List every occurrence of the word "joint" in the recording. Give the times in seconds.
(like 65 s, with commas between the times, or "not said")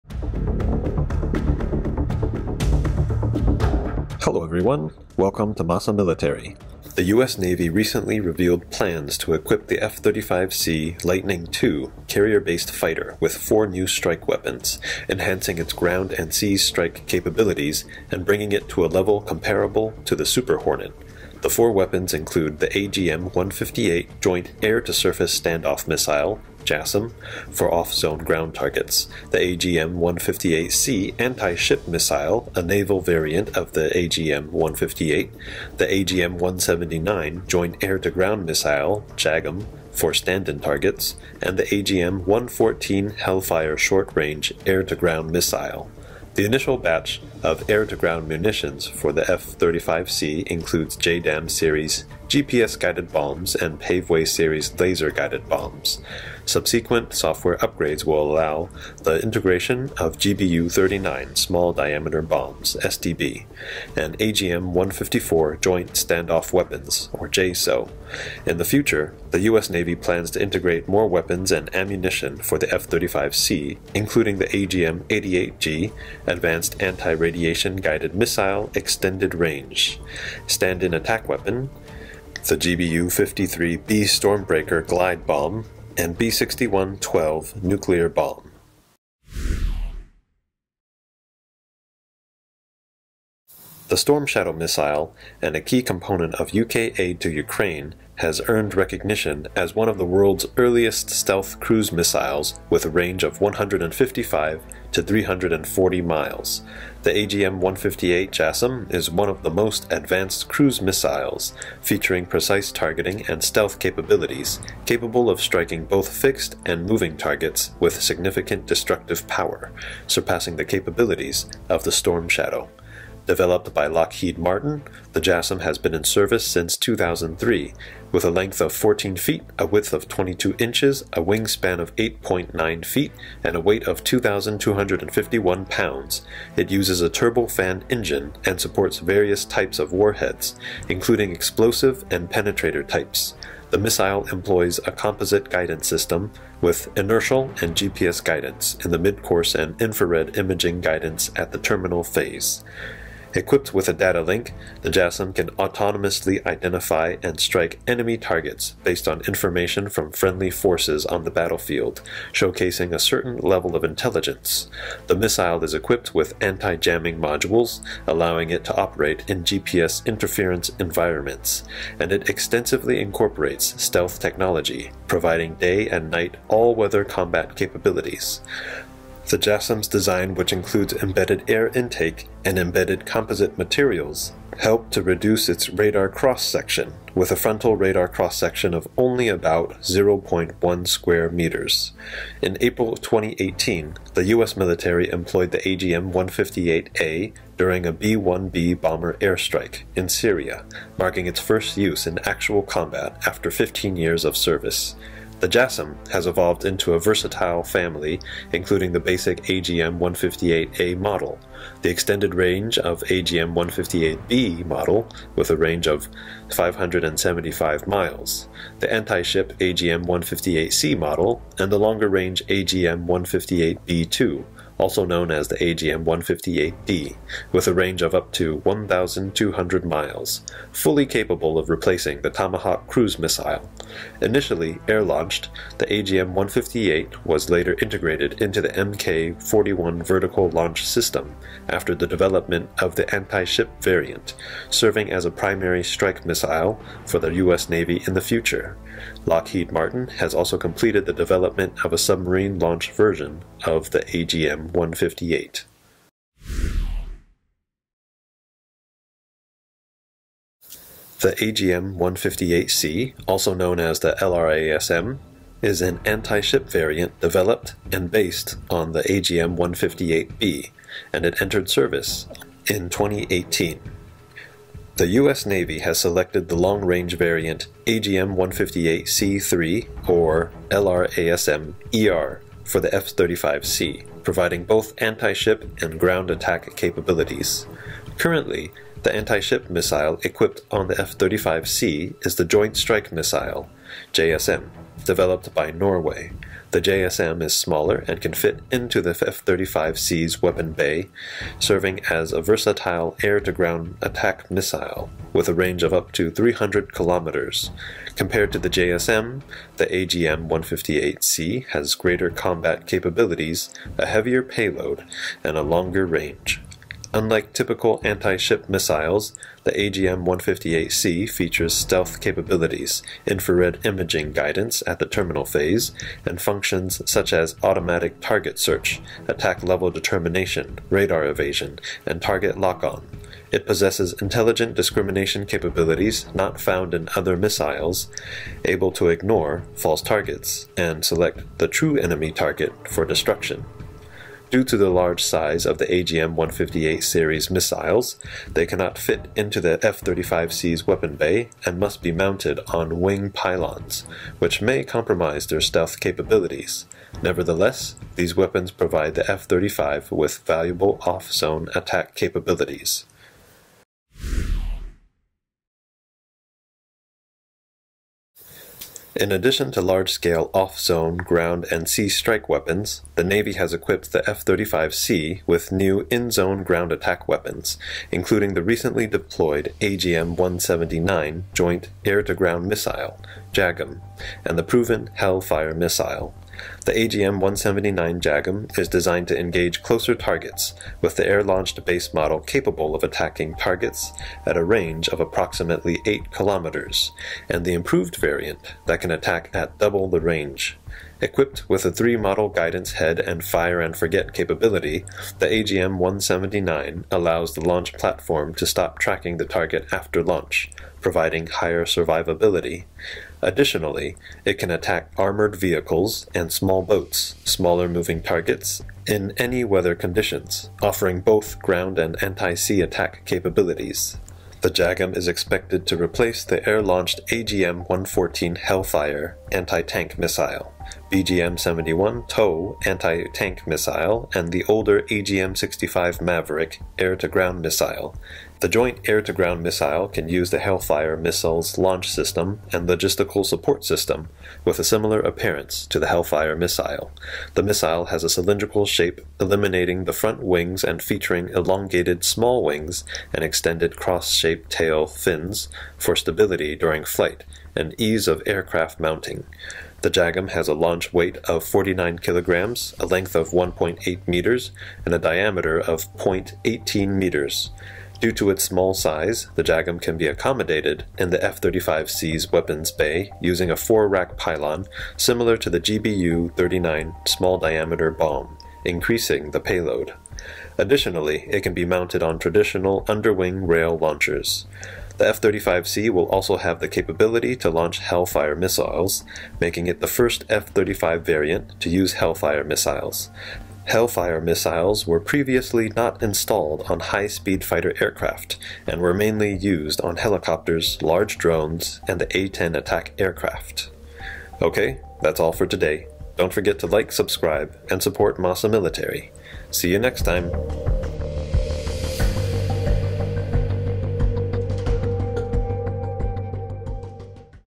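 24 s, 37 s, 65 s, 292 s, 381 s, 438 s.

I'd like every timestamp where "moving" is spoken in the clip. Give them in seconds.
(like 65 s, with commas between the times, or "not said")
116 s, 417 s.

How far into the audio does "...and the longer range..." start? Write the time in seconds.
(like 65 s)
221 s.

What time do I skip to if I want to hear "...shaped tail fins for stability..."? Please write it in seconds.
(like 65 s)
454 s.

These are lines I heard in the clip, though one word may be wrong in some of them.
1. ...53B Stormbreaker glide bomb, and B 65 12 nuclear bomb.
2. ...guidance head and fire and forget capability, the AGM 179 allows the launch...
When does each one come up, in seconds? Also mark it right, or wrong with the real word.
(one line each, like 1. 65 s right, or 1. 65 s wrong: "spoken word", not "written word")
1. 83 s wrong: "61", not "65"
2. 402 s right.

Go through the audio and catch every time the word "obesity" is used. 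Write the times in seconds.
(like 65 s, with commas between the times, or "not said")
not said.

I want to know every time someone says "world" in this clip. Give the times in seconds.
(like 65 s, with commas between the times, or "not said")
100 s.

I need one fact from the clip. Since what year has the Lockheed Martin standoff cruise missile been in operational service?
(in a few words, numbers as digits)
2003.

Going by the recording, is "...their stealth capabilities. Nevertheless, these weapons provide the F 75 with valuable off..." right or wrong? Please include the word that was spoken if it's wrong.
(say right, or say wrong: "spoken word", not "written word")
wrong: "35", not "75".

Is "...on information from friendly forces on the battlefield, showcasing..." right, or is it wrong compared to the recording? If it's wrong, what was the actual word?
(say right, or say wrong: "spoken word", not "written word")
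right.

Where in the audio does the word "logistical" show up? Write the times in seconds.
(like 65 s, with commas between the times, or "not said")
442 s.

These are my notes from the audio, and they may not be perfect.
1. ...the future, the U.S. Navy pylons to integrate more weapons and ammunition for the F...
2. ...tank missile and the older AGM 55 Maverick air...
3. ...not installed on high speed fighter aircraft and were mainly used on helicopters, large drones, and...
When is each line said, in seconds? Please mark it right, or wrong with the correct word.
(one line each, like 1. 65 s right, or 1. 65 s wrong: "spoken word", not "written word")
1. 68 s wrong: "plans", not "pylons"
2. 433 s wrong: "65", not "55"
3. 495 s right.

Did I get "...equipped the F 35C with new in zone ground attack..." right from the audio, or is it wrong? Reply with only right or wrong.
right.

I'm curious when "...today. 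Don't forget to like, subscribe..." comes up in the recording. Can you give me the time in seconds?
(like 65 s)
505 s.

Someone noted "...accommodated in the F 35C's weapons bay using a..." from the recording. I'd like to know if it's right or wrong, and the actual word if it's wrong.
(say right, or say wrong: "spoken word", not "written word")
right.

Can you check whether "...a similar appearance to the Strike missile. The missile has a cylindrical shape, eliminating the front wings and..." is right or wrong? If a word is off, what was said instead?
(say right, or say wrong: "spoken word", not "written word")
wrong: "Hellfire", not "Strike".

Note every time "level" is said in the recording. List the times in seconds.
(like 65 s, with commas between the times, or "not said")
18 s, 163 s, 329 s.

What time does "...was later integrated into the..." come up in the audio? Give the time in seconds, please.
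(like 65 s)
237 s.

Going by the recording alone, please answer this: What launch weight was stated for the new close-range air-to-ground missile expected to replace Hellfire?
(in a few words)
49 kilograms.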